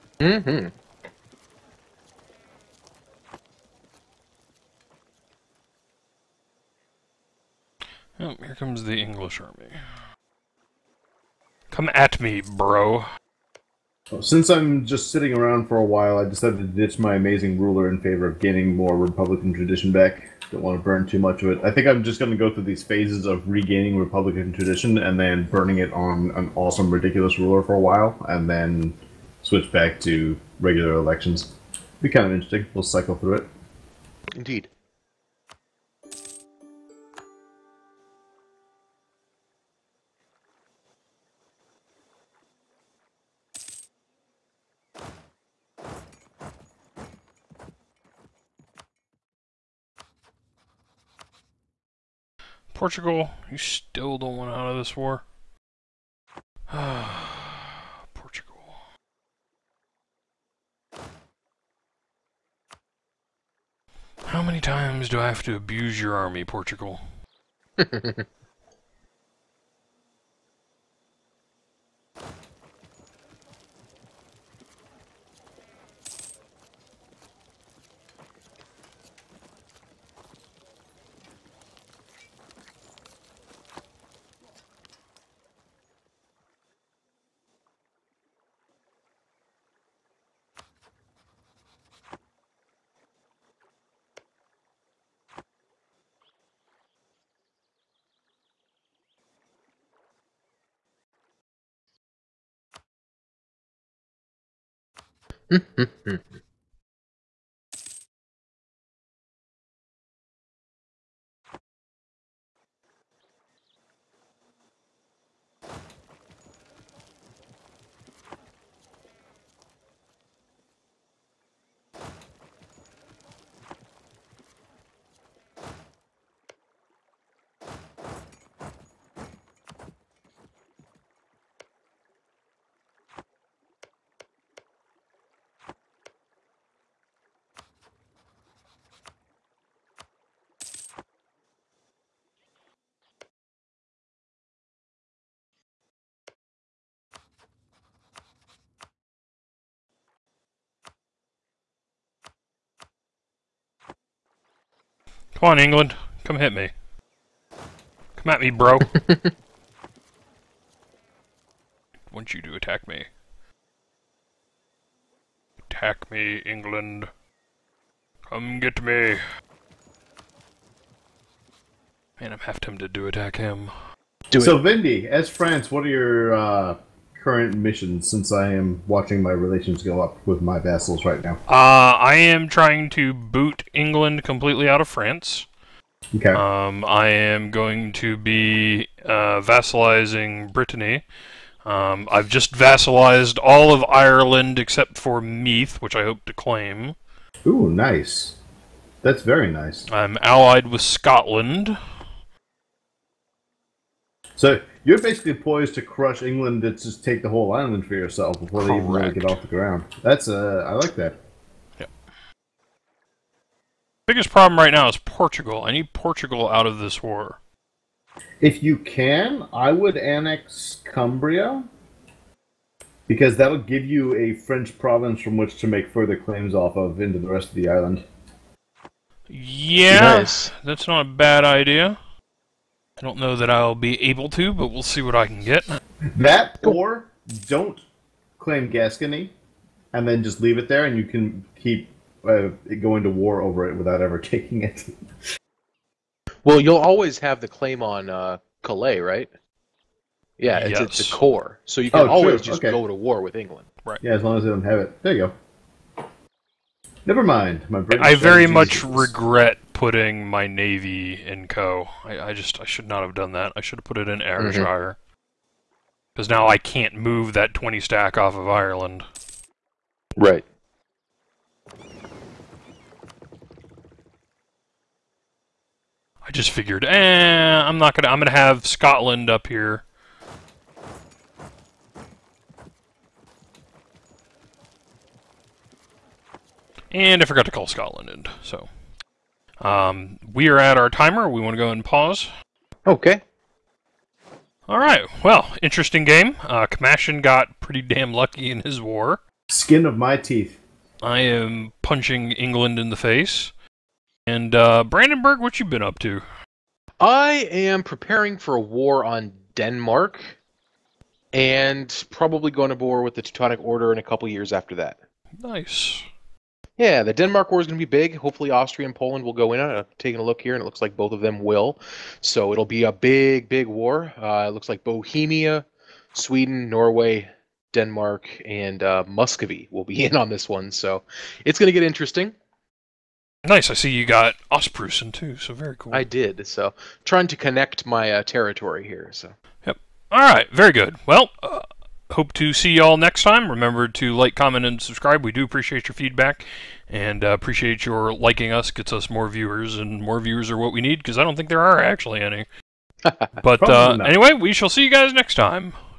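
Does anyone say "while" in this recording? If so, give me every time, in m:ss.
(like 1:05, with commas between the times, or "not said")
0:15, 0:27.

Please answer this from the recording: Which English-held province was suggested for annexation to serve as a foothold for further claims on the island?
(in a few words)
Cumbria.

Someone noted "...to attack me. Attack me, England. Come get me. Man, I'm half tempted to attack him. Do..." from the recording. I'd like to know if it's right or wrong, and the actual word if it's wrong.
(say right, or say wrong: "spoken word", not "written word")
right.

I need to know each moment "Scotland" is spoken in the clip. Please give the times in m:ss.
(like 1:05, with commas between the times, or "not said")
3:20, 4:38, 4:47.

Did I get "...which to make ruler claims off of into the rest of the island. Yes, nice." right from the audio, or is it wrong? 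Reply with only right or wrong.
wrong.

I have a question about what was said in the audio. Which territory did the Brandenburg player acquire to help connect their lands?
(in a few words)
Ostpreussen.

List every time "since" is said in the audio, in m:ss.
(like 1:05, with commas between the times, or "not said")
0:14, 2:58.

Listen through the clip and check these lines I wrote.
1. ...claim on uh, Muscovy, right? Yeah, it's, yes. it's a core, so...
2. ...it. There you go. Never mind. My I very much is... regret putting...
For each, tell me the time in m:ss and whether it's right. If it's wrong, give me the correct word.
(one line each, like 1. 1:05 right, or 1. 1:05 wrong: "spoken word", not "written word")
1. 4:07 wrong: "Calais", not "Muscovy"
2. 4:14 right.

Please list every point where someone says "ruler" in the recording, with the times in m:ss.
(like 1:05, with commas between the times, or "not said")
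0:17, 0:27.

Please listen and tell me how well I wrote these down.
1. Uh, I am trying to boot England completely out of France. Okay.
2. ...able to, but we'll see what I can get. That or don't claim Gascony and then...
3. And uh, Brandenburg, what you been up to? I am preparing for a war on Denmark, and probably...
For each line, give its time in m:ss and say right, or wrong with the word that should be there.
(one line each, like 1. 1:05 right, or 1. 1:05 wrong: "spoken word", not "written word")
1. 3:01 right
2. 3:54 right
3. 5:04 right.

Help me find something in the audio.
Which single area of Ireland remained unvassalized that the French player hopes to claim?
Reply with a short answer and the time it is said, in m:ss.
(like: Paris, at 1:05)
Meath, at 3:15.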